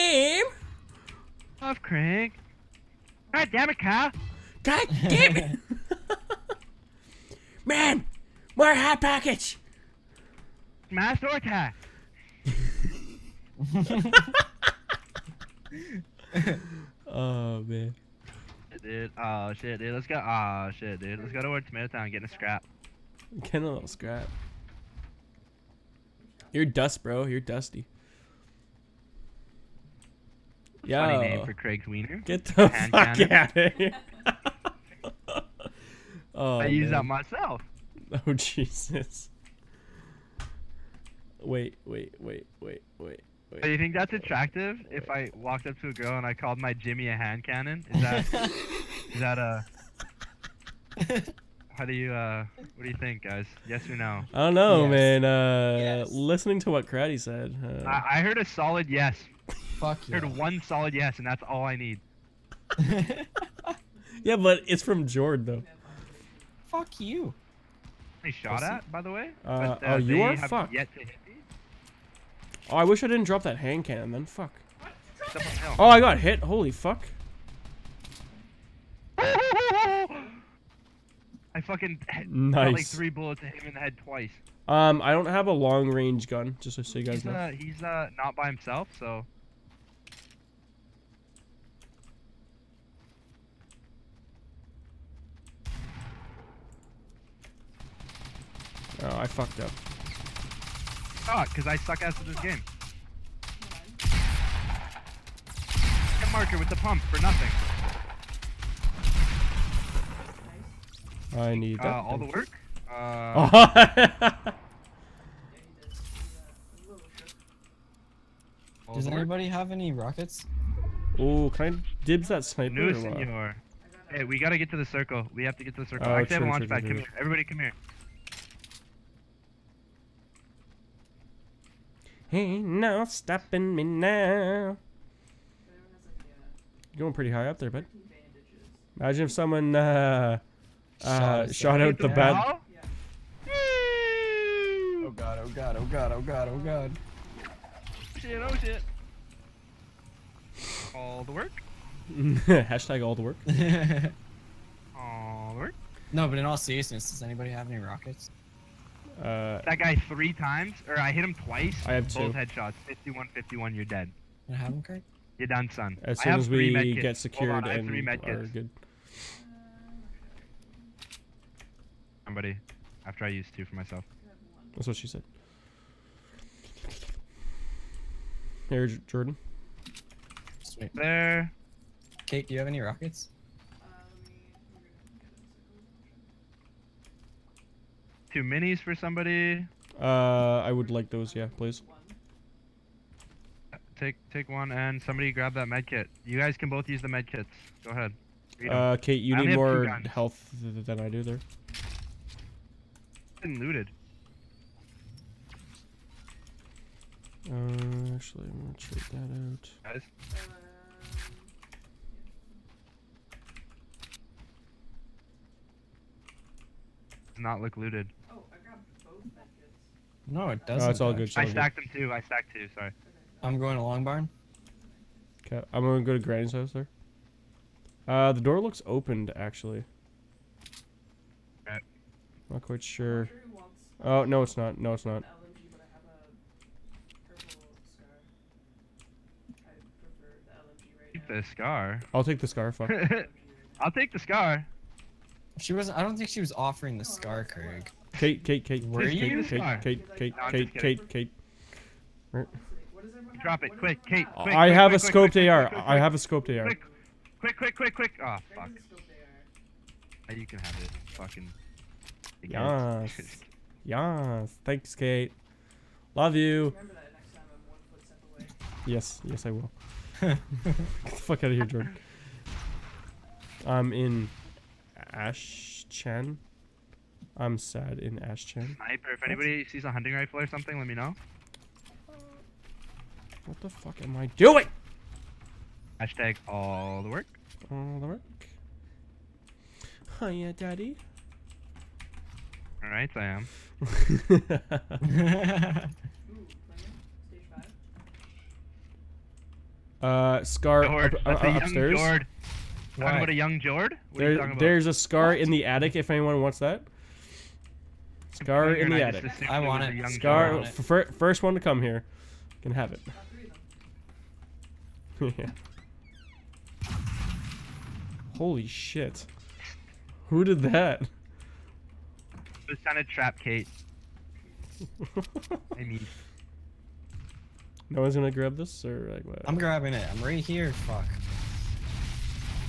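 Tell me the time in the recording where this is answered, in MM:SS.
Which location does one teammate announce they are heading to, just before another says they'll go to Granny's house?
03:43.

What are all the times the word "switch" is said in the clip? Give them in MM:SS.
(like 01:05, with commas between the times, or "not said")
not said.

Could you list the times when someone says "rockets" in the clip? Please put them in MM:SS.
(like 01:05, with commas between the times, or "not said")
01:59, 02:37, 03:02.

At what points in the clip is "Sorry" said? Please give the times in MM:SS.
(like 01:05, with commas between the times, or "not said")
03:42.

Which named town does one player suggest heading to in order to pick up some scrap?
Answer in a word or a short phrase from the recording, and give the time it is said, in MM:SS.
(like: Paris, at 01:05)
Tomato Town, at 00:21.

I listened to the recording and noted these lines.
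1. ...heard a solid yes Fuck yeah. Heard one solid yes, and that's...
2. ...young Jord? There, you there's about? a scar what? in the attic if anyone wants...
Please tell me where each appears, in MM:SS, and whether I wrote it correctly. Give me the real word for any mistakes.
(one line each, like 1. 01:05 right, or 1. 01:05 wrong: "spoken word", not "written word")
1. 00:58 right
2. 05:03 right.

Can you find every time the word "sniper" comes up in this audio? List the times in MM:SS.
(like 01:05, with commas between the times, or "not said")
02:02, 04:38.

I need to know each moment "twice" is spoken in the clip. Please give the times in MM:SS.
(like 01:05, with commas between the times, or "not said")
01:24, 02:41.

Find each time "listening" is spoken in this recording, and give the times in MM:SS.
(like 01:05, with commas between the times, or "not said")
00:56.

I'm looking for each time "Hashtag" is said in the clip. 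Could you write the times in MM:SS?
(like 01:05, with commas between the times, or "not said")
02:32, 04:45.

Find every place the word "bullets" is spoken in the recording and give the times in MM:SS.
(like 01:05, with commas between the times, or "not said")
01:23.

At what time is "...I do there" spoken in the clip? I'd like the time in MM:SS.
03:20.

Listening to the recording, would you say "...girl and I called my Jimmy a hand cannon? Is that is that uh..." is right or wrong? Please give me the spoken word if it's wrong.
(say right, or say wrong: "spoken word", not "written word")
right.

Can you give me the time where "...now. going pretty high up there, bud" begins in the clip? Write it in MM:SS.
02:13.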